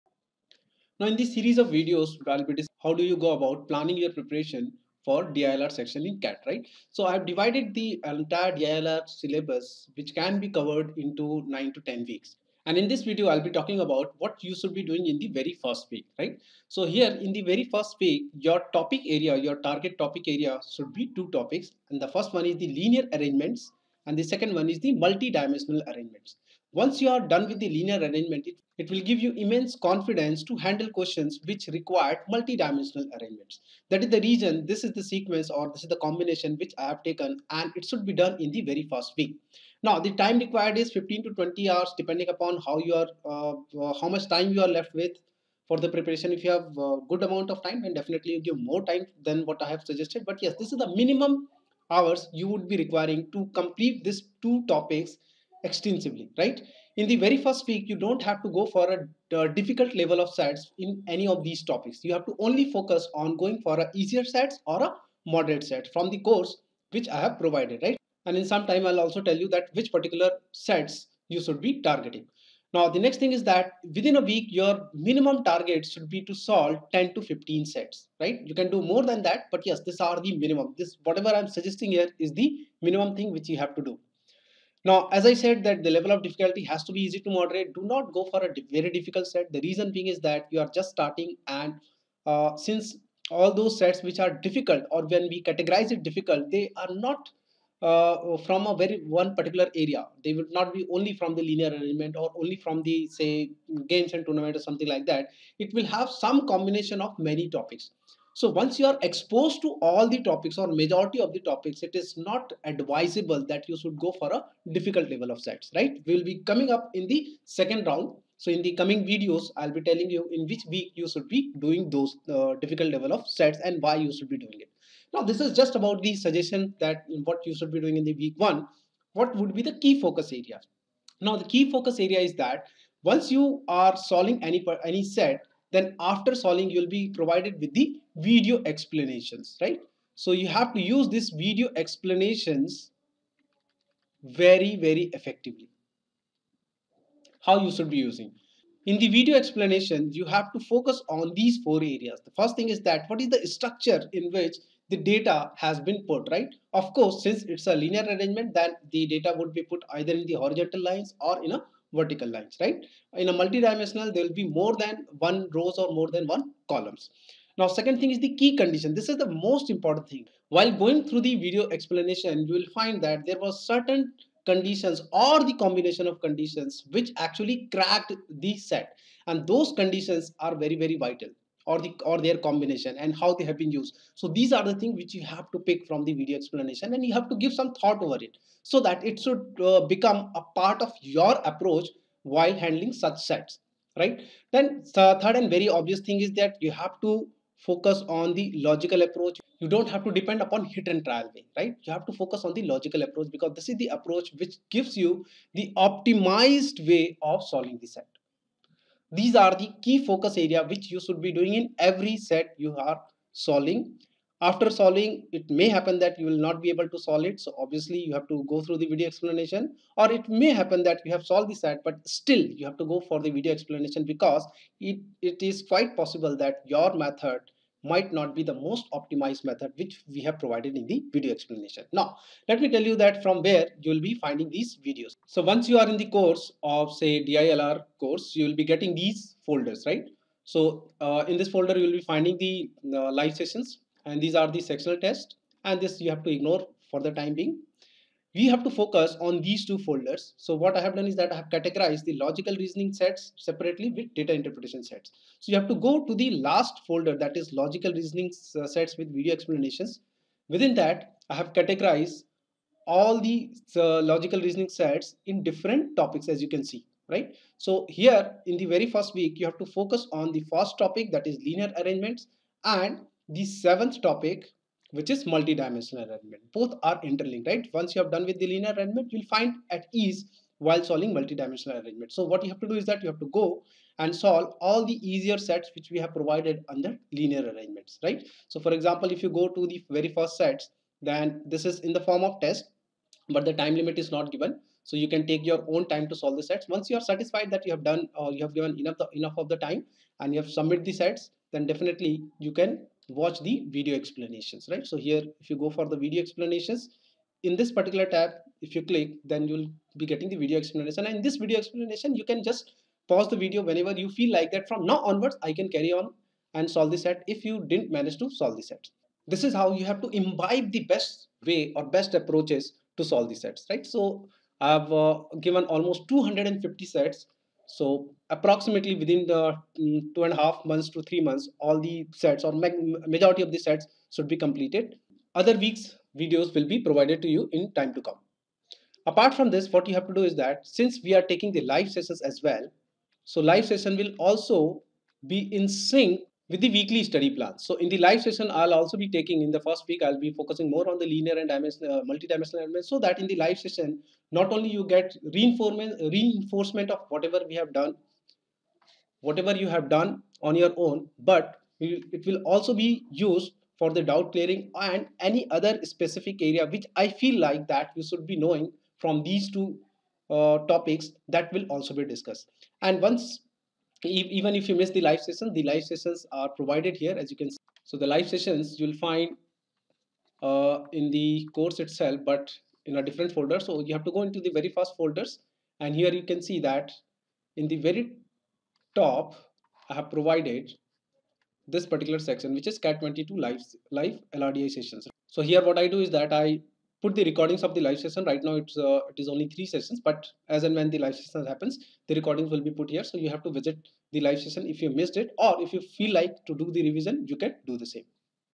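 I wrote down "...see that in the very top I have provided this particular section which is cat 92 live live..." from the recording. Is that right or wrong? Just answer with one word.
wrong.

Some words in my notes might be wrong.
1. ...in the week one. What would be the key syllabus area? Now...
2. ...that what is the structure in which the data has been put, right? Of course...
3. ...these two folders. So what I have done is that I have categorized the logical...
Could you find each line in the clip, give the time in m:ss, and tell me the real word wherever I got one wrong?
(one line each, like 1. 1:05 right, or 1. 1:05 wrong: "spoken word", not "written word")
1. 2:07 wrong: "focus", not "syllabus"
2. 2:32 right
3. 4:09 right.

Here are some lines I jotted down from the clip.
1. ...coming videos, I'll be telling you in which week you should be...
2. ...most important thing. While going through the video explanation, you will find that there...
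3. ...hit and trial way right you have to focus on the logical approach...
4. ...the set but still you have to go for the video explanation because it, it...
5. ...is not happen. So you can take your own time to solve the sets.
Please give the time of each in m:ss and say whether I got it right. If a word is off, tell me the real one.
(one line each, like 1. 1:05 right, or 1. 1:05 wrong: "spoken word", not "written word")
1. 1:58 right
2. 2:49 right
3. 3:20 right
4. 3:41 right
5. 4:53 wrong: "given", not "happen".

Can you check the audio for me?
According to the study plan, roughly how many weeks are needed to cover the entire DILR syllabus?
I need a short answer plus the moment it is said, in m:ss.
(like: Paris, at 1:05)
9 to 10 weeks, at 0:11.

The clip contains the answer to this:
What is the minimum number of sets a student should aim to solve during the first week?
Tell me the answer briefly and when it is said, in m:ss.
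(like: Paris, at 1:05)
10 to 15 sets, at 1:16.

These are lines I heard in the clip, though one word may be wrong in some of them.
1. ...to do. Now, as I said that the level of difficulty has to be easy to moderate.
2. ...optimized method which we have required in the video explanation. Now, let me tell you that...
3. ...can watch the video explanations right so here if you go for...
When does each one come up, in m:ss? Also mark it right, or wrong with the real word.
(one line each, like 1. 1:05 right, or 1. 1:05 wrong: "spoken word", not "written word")
1. 1:23 right
2. 3:48 wrong: "provided", not "required"
3. 5:02 right.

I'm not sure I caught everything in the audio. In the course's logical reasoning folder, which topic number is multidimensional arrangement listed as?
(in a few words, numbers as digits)
Seventh.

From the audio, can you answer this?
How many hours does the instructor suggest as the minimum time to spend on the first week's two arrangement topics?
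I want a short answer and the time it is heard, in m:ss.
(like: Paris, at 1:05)
15 to 20 hours, at 0:40.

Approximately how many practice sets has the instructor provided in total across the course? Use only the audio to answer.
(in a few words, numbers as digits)
250.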